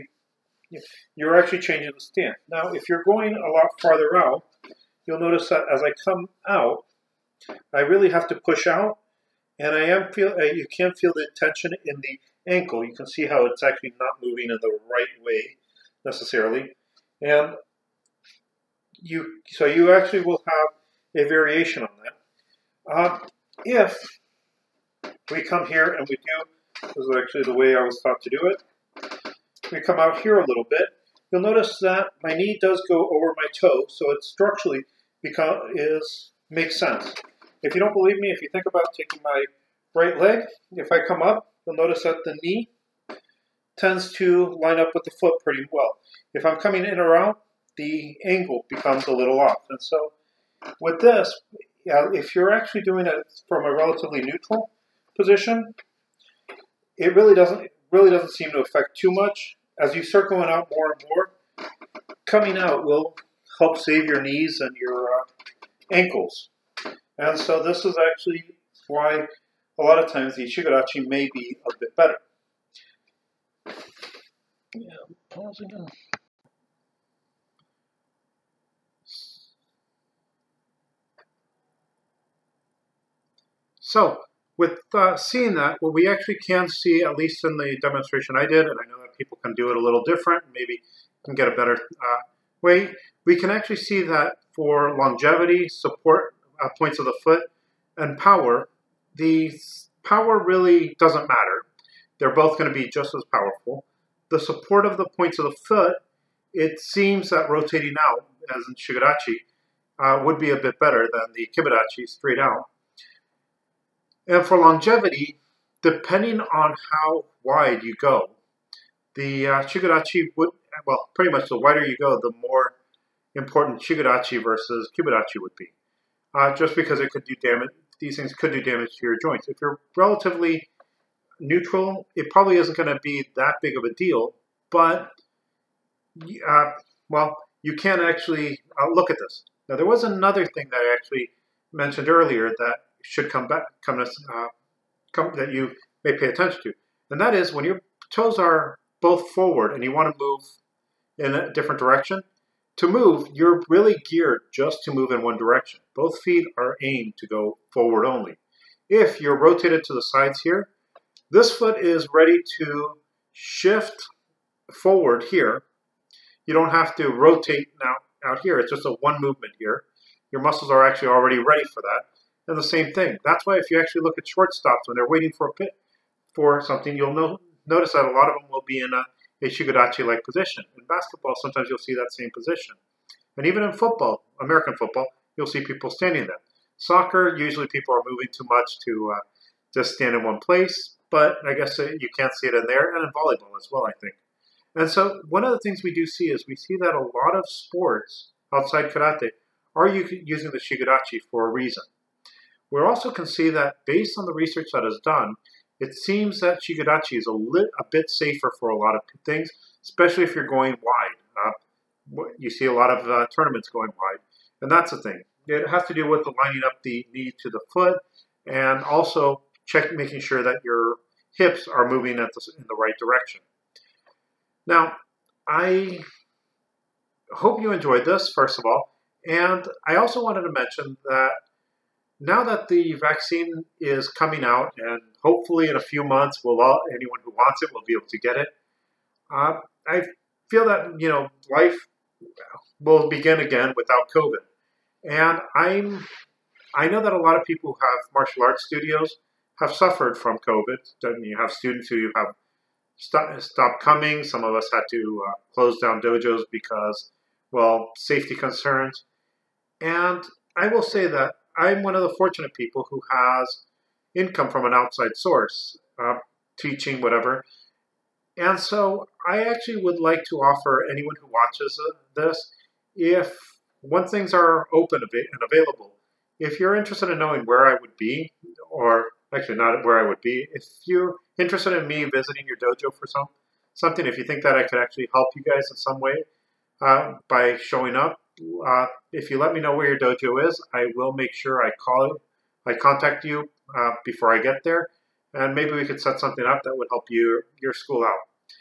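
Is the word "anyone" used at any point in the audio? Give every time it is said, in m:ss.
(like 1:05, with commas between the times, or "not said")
3:56, 4:30.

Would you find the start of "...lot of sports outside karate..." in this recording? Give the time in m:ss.
3:16.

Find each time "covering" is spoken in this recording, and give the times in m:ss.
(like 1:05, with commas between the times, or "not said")
not said.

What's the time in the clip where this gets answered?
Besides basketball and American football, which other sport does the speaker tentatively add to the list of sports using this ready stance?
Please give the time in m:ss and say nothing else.
3:13.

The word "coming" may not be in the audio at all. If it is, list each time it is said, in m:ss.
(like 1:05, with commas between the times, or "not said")
0:46, 1:02, 3:54, 4:13.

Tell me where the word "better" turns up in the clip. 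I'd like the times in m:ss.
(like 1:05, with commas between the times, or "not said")
1:11, 1:31, 1:50.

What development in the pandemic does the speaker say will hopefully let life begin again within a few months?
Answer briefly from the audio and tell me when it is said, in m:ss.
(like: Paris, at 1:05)
The vaccine, at 3:52.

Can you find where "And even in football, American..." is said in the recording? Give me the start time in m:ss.
3:03.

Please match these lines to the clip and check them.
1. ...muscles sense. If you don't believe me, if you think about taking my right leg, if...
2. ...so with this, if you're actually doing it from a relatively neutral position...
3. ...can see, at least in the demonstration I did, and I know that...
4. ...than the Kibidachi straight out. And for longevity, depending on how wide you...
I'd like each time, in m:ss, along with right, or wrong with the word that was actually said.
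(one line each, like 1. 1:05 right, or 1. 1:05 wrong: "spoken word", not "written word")
1. 0:36 wrong: "makes", not "muscles"
2. 0:49 right
3. 1:26 right
4. 1:51 right.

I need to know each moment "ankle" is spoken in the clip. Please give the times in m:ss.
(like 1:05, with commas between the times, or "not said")
0:12, 1:05.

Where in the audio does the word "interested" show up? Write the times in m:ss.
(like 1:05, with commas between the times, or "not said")
4:36, 4:41.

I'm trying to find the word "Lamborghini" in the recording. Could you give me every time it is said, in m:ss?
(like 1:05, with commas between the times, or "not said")
not said.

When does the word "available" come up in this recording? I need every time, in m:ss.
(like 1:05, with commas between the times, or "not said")
4:35.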